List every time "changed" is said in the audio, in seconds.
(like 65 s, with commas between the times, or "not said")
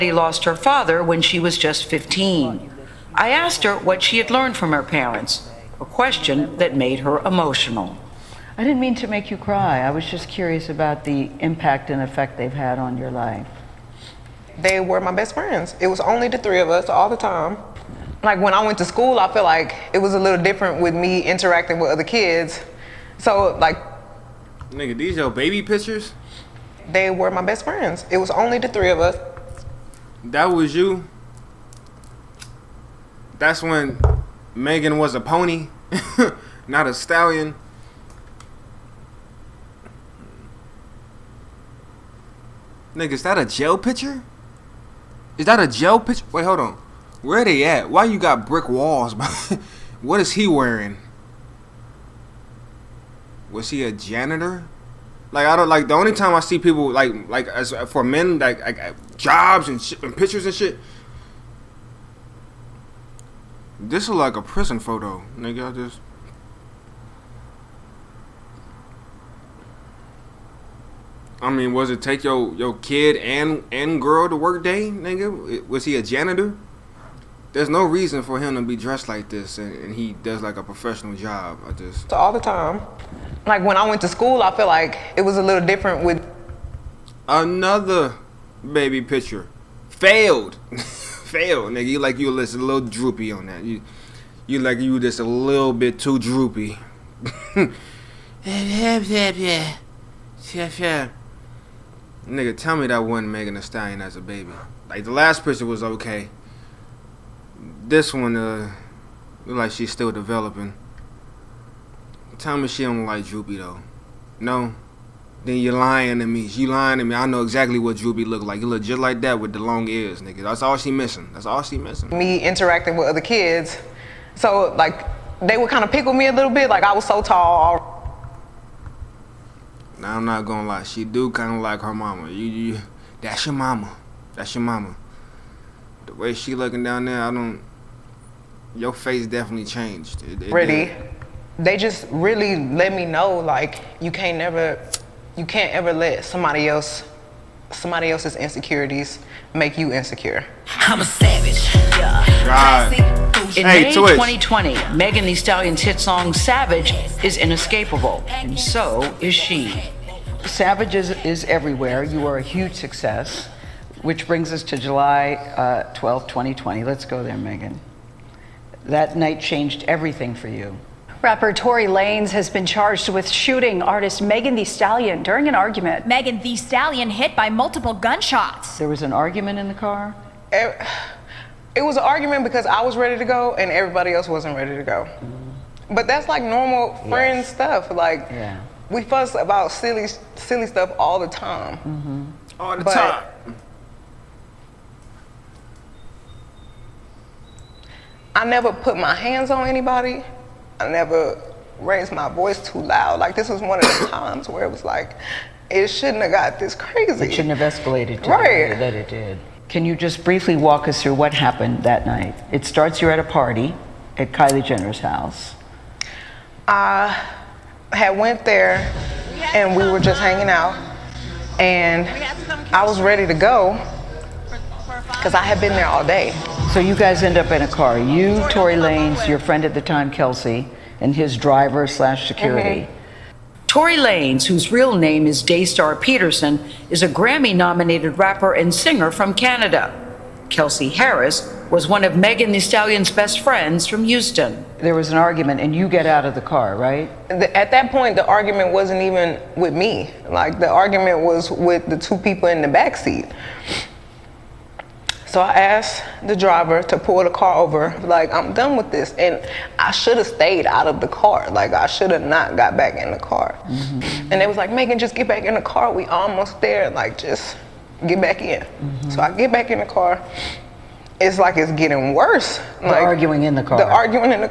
139 s, 169 s.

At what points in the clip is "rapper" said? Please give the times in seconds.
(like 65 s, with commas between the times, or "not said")
171 s, 238 s.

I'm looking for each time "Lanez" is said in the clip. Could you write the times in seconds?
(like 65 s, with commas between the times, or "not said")
171 s, 228 s, 233 s.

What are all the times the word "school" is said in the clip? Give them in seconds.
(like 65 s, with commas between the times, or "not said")
18 s, 84 s.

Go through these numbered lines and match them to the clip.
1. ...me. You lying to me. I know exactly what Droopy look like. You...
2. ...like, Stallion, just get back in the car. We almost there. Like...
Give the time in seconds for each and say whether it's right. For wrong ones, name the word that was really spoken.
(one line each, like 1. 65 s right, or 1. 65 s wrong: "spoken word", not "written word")
1. 116 s right
2. 264 s wrong: "Megan", not "Stallion".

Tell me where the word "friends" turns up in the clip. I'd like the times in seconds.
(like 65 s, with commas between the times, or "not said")
15 s, 27 s, 187 s, 229 s, 243 s.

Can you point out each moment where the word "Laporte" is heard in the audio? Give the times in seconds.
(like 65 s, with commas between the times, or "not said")
not said.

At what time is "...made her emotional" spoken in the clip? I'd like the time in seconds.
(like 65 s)
6 s.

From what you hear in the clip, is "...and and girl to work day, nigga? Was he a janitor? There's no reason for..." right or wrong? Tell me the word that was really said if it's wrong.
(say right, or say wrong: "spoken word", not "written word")
right.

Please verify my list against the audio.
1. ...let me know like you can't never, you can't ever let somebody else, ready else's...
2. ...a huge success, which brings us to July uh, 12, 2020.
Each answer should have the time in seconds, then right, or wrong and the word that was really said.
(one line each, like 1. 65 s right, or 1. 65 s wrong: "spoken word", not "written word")
1. 142 s wrong: "somebody", not "ready"
2. 162 s right.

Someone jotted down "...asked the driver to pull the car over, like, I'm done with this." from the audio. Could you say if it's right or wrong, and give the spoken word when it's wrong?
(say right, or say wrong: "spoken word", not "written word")
right.